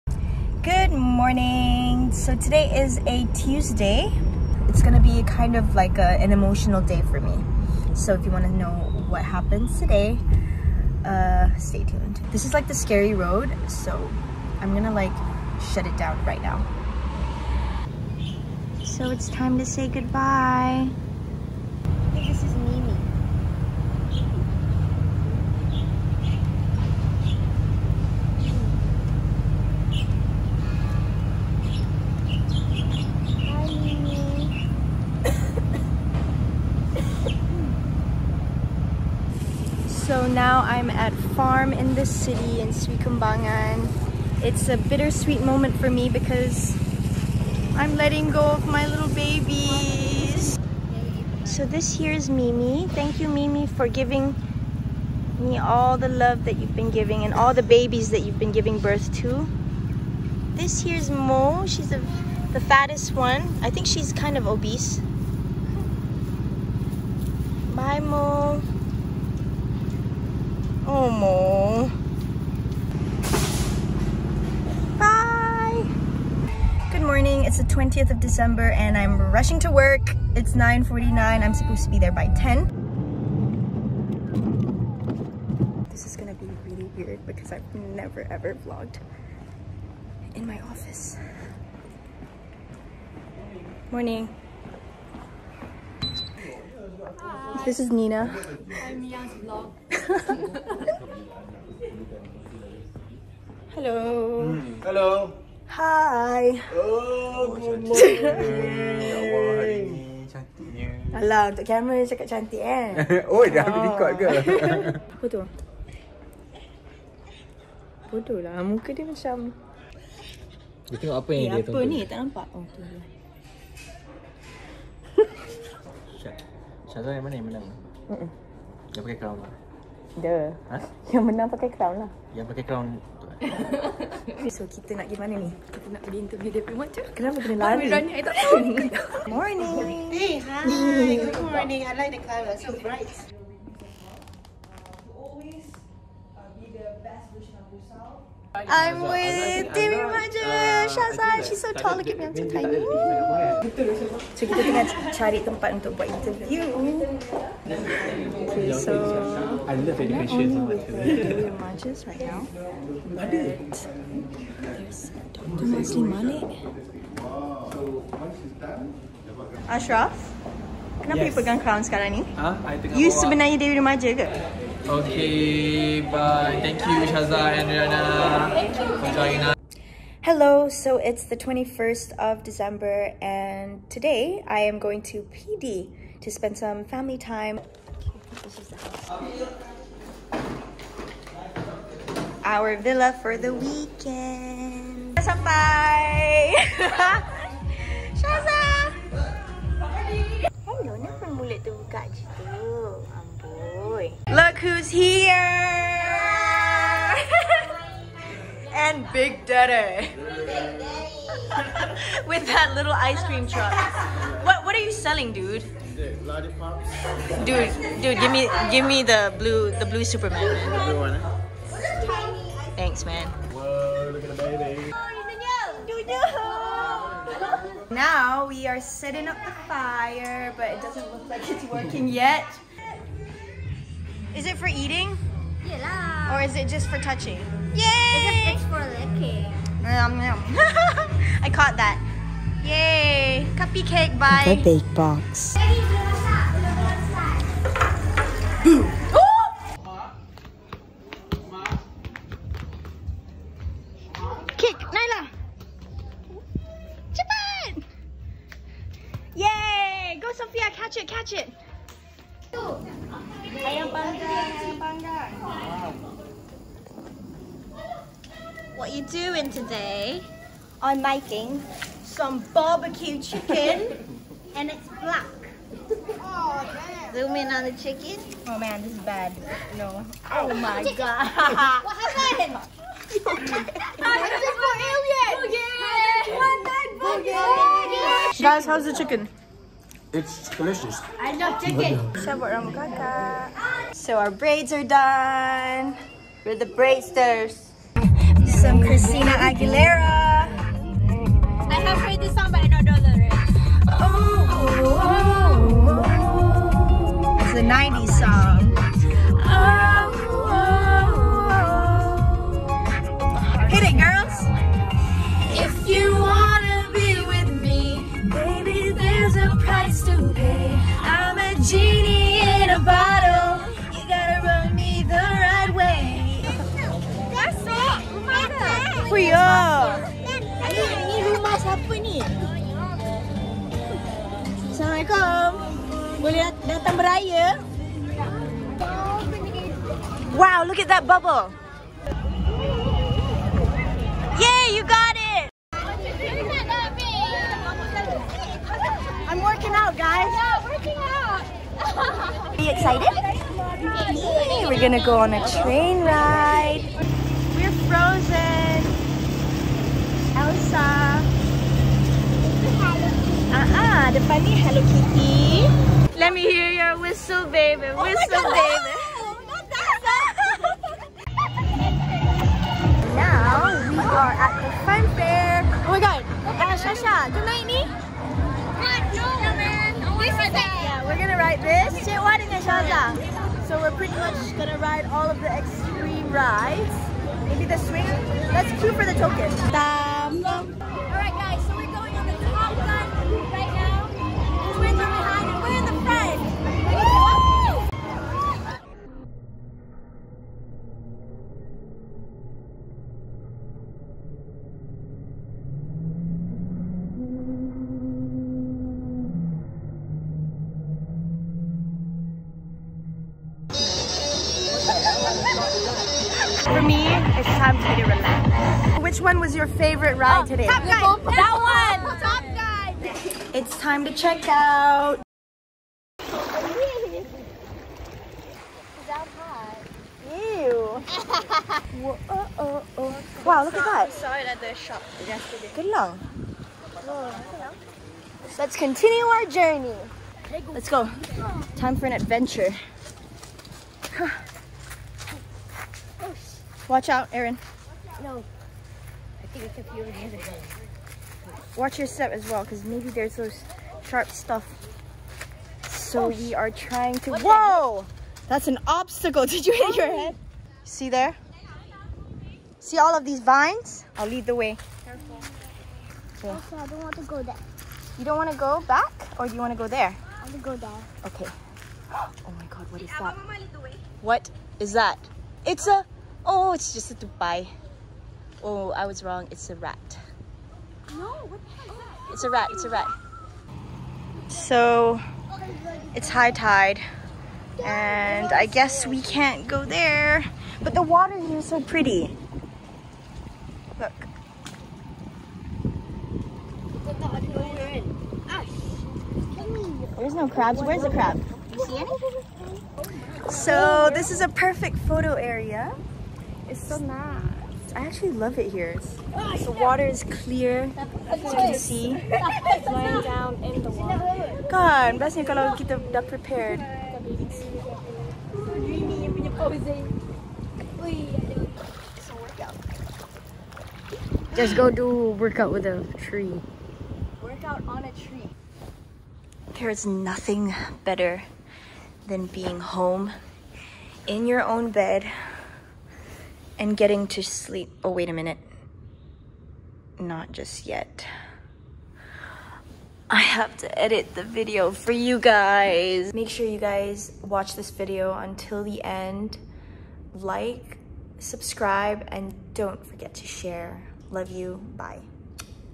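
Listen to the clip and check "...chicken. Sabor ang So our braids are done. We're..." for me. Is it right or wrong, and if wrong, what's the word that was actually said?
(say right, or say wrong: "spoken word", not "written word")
right.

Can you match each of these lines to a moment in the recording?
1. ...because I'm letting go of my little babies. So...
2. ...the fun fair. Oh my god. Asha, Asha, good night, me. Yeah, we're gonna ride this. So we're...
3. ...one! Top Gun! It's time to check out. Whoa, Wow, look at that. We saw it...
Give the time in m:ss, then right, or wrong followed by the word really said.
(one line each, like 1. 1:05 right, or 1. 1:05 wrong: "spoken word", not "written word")
1. 0:46 right
2. 6:14 right
3. 7:02 right.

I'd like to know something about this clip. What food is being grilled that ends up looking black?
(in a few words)
barbecue chicken.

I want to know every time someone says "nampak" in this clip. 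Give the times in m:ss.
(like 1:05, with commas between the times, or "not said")
2:02.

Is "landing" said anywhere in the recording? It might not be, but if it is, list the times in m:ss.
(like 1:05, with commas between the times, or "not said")
not said.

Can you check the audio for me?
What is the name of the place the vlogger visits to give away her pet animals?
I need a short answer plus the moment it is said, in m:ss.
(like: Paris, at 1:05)
Farm in the City, at 0:41.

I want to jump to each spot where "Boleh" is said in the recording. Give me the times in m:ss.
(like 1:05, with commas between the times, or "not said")
5:36.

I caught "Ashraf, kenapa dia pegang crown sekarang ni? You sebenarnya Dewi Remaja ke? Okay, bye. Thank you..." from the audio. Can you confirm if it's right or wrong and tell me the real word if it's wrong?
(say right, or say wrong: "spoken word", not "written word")
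right.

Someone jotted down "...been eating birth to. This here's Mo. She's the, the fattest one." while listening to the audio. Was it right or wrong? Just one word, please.
wrong.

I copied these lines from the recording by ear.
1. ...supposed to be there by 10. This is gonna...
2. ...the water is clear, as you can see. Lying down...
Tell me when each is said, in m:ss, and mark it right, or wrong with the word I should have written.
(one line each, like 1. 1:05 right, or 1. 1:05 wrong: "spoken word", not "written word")
1. 1:21 right
2. 8:29 right.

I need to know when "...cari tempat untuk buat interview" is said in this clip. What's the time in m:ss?
2:35.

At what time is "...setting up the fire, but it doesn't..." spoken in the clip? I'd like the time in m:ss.
3:48.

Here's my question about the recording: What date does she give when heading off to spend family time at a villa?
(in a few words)
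21st of December.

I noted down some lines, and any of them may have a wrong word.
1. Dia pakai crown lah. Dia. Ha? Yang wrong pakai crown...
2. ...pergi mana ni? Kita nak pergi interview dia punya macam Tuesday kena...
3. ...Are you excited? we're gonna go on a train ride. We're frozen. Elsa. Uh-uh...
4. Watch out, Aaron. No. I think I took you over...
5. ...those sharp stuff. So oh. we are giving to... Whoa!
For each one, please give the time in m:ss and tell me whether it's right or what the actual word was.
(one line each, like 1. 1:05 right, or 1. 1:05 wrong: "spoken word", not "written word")
1. 2:08 wrong: "menang", not "wrong"
2. 2:15 wrong: "Kenapa", not "Tuesday"
3. 5:52 right
4. 7:26 right
5. 7:33 wrong: "trying", not "giving".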